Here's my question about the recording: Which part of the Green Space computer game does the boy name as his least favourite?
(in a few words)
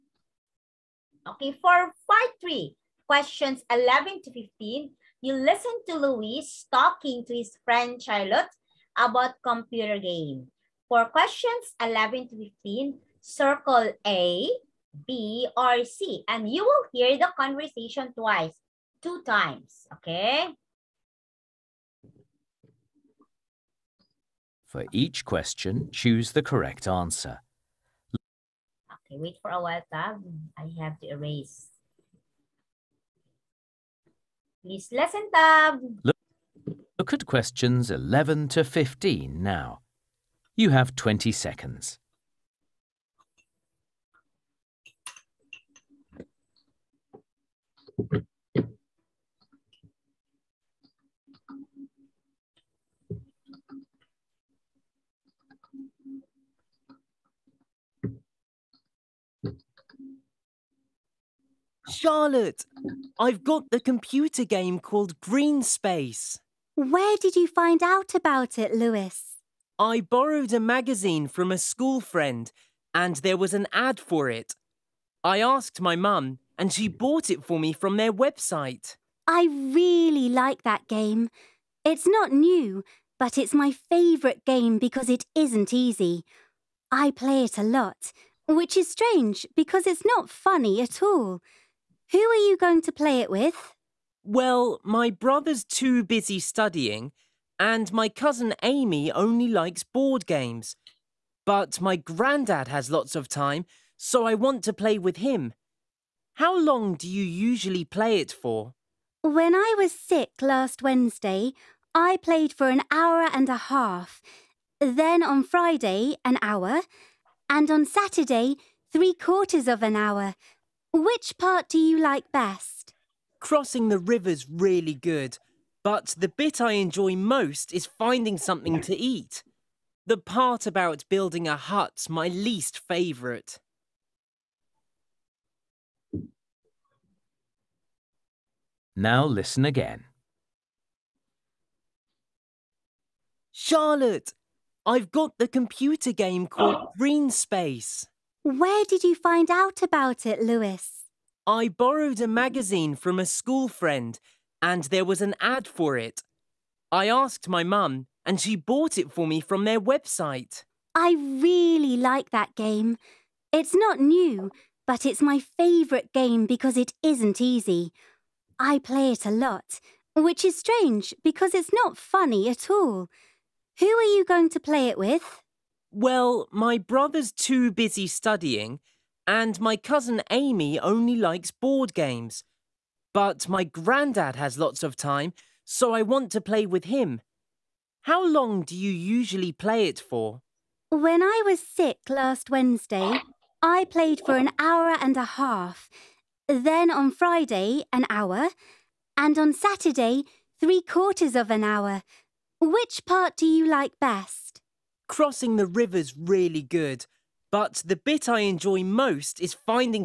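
building a hut.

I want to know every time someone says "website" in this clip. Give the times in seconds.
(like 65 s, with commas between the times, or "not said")
78 s, 159 s.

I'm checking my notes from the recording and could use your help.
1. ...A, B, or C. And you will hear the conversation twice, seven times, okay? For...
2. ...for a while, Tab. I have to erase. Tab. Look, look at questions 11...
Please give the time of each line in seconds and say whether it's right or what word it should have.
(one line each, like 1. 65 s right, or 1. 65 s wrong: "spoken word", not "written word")
1. 14 s wrong: "two", not "seven"
2. 29 s right.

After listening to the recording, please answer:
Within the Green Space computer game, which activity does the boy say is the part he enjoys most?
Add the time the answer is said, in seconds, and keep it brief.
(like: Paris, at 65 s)
finding something to eat, at 127 s.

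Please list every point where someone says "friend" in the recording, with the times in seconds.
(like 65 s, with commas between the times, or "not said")
7 s, 71 s, 153 s.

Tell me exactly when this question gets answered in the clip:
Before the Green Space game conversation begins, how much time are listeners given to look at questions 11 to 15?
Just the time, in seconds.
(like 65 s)
40 s.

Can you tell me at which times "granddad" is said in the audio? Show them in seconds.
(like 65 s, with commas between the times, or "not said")
101 s, 183 s.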